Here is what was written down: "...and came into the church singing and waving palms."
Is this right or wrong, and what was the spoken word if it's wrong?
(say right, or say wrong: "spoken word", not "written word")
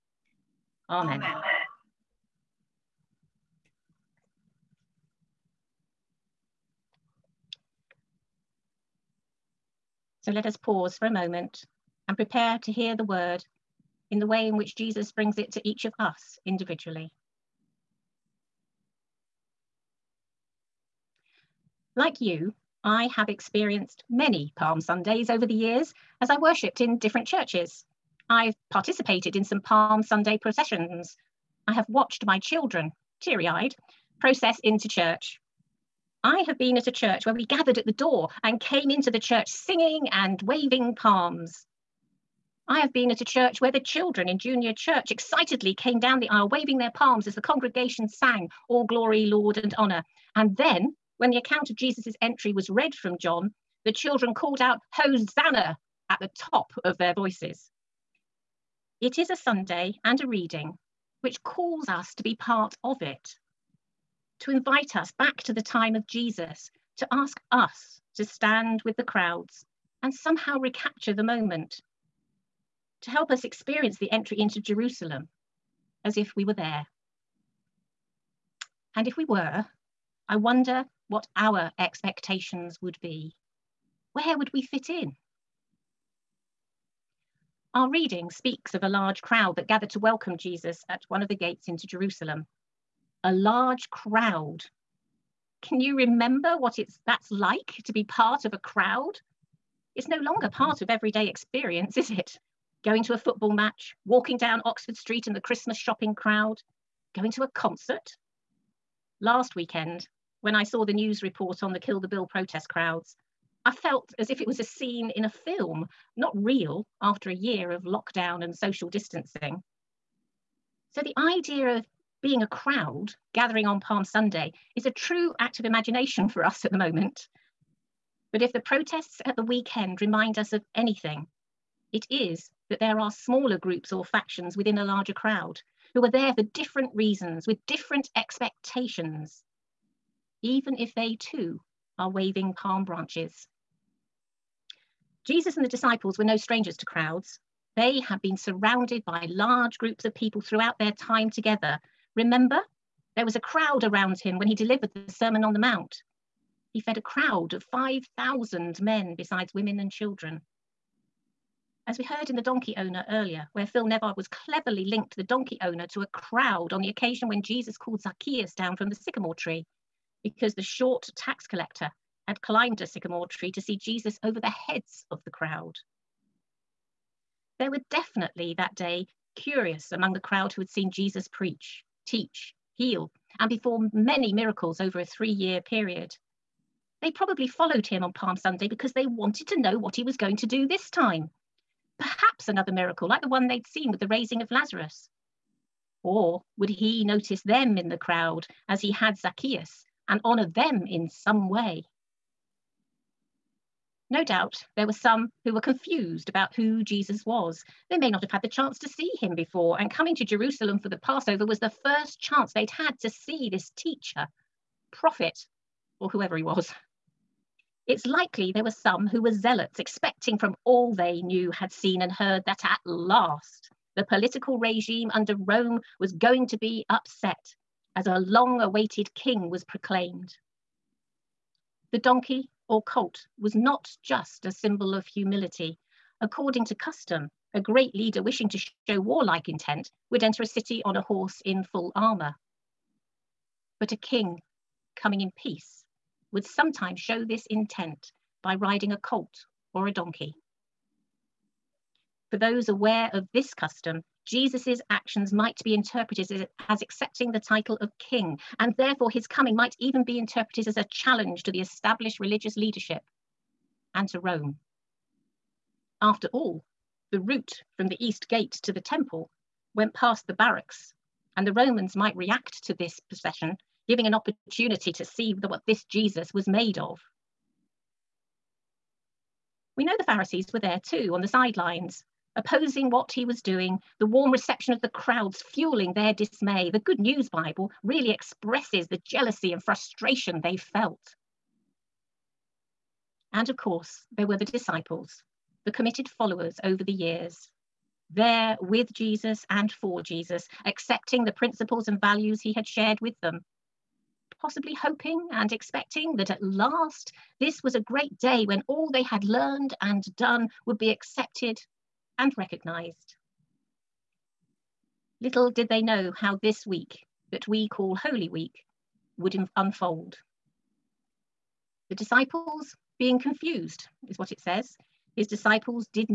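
right.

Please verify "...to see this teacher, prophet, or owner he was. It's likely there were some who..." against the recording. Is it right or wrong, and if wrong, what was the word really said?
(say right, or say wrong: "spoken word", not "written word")
wrong: "whoever", not "owner".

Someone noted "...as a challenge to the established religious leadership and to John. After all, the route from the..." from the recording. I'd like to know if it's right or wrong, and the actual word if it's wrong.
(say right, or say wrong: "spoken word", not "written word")
wrong: "Rome", not "John".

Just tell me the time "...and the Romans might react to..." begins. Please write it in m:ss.
4:31.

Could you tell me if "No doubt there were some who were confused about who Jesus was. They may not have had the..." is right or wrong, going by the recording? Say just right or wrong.
right.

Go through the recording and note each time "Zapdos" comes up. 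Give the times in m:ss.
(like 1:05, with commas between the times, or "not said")
not said.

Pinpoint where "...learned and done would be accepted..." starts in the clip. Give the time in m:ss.
5:09.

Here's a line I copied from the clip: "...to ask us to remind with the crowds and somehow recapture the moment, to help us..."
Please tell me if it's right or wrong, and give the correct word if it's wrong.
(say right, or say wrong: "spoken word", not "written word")
wrong: "stand", not "remind".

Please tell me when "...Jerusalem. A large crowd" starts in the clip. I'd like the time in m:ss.
1:31.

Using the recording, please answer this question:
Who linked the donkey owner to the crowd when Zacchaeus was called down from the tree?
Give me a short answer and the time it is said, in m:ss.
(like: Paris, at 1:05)
Phil Nevard, at 2:43.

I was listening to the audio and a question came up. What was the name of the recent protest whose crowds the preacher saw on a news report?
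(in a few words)
Kill the Bill.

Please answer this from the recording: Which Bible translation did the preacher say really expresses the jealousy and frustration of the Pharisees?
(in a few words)
Good News Bible.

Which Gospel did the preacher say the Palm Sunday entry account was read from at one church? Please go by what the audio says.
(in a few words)
John.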